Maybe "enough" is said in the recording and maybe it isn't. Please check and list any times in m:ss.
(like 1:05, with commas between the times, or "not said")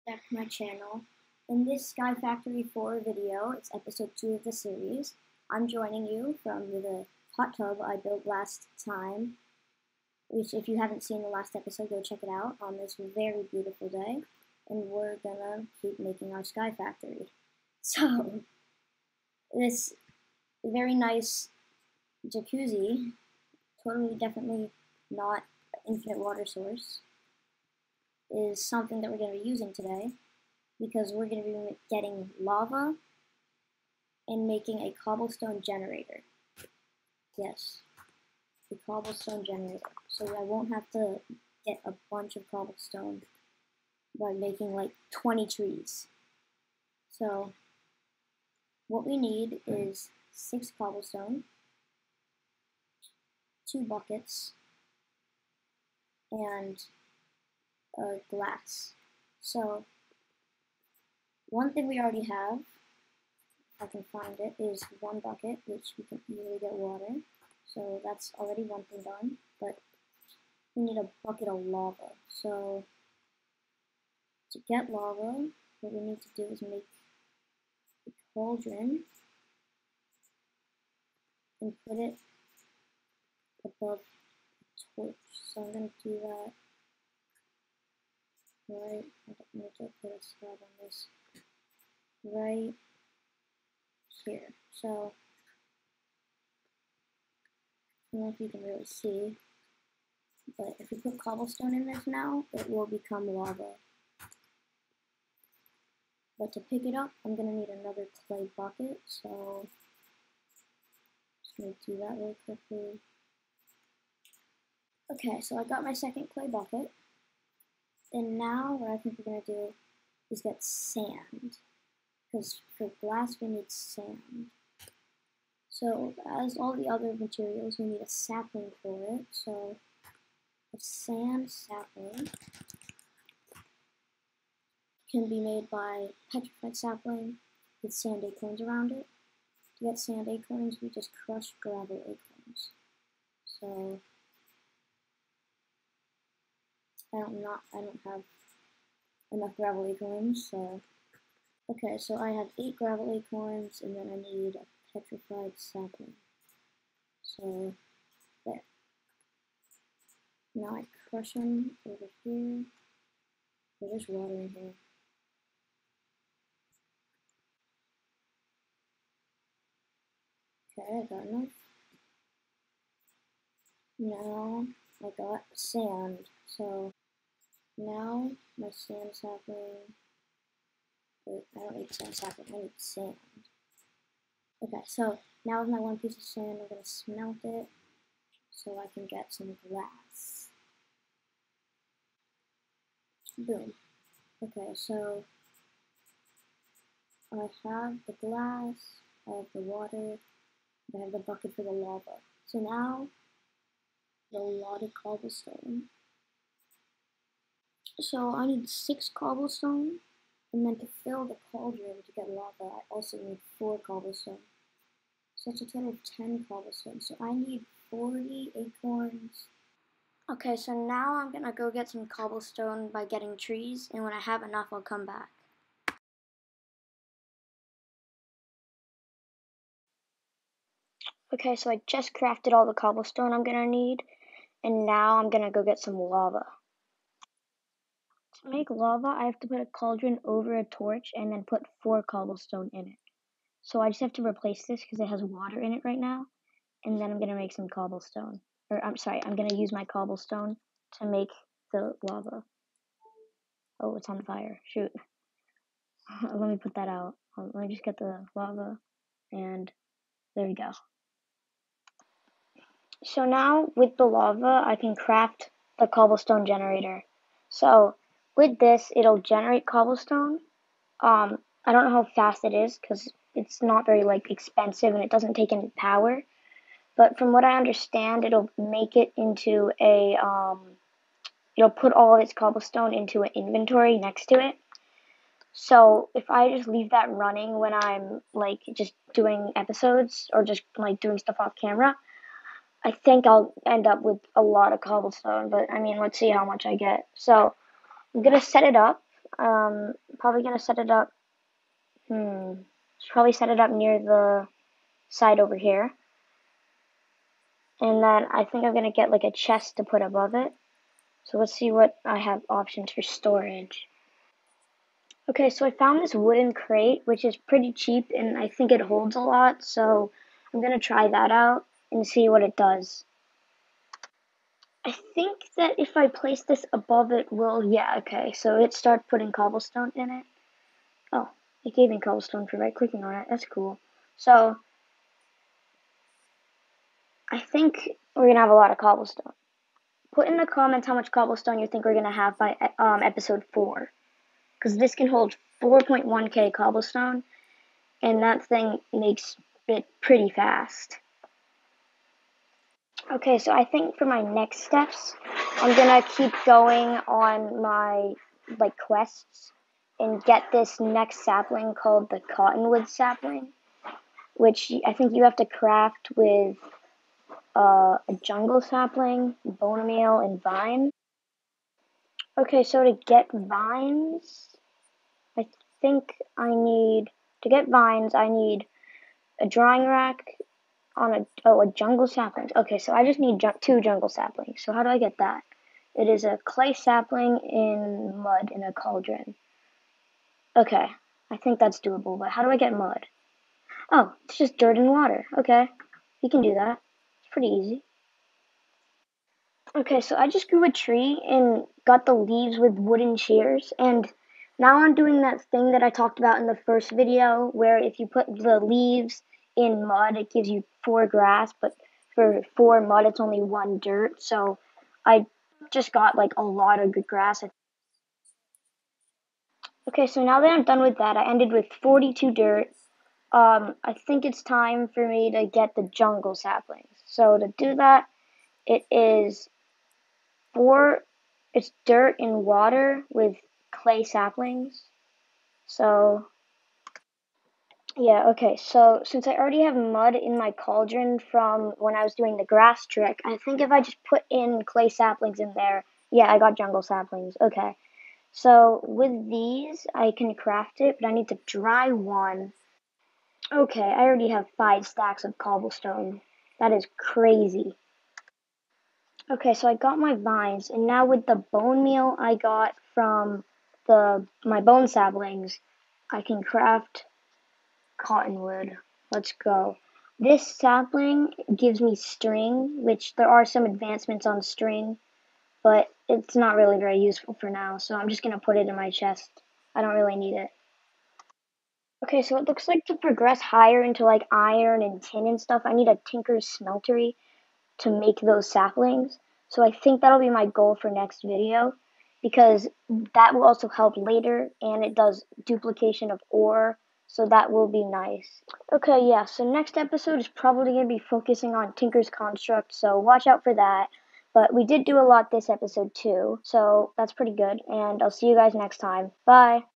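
2:29, 2:51, 3:44.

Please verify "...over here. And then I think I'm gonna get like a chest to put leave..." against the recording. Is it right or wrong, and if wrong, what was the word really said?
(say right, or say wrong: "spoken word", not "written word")
wrong: "above", not "leave".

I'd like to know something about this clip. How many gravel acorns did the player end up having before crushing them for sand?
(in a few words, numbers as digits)
8.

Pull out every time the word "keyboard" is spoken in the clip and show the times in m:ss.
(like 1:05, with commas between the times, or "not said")
not said.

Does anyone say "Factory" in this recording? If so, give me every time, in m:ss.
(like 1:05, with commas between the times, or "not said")
0:02, 0:16.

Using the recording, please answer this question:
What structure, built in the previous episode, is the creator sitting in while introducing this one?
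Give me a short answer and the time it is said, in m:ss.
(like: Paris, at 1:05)
hot tub, at 0:07.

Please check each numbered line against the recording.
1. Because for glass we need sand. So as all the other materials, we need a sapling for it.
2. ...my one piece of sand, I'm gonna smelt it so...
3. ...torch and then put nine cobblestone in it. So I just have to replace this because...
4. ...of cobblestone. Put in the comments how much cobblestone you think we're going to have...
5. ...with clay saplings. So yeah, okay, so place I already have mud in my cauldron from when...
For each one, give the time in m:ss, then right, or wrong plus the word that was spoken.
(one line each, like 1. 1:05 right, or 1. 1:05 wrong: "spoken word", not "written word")
1. 2:02 right
2. 3:05 right
3. 4:00 wrong: "four", not "nine"
4. 5:38 right
5. 7:13 wrong: "since", not "place".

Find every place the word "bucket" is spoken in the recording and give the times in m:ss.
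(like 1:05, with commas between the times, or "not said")
0:53, 1:05, 1:11, 1:48, 1:56, 3:21.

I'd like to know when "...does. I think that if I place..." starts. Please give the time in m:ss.
5:22.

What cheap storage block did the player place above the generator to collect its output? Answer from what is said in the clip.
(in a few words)
wooden crate.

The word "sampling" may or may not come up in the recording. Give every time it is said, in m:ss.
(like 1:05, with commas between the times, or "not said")
not said.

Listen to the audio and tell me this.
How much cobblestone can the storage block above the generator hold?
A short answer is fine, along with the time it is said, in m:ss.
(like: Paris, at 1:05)
4.1k, at 5:45.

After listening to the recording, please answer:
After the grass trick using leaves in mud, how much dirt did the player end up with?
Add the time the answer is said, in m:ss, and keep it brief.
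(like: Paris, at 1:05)
42, at 7:01.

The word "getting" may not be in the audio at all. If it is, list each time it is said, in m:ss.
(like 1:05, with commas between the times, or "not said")
0:31, 3:43.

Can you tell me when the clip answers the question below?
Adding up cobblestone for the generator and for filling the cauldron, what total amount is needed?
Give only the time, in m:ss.
3:36.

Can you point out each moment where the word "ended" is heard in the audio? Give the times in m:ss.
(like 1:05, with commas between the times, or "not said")
7:01.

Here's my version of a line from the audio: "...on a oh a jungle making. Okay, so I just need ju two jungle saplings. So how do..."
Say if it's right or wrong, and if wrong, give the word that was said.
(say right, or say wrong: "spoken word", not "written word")
wrong: "sapling", not "making".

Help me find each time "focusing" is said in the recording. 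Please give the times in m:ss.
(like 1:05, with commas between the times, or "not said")
8:21.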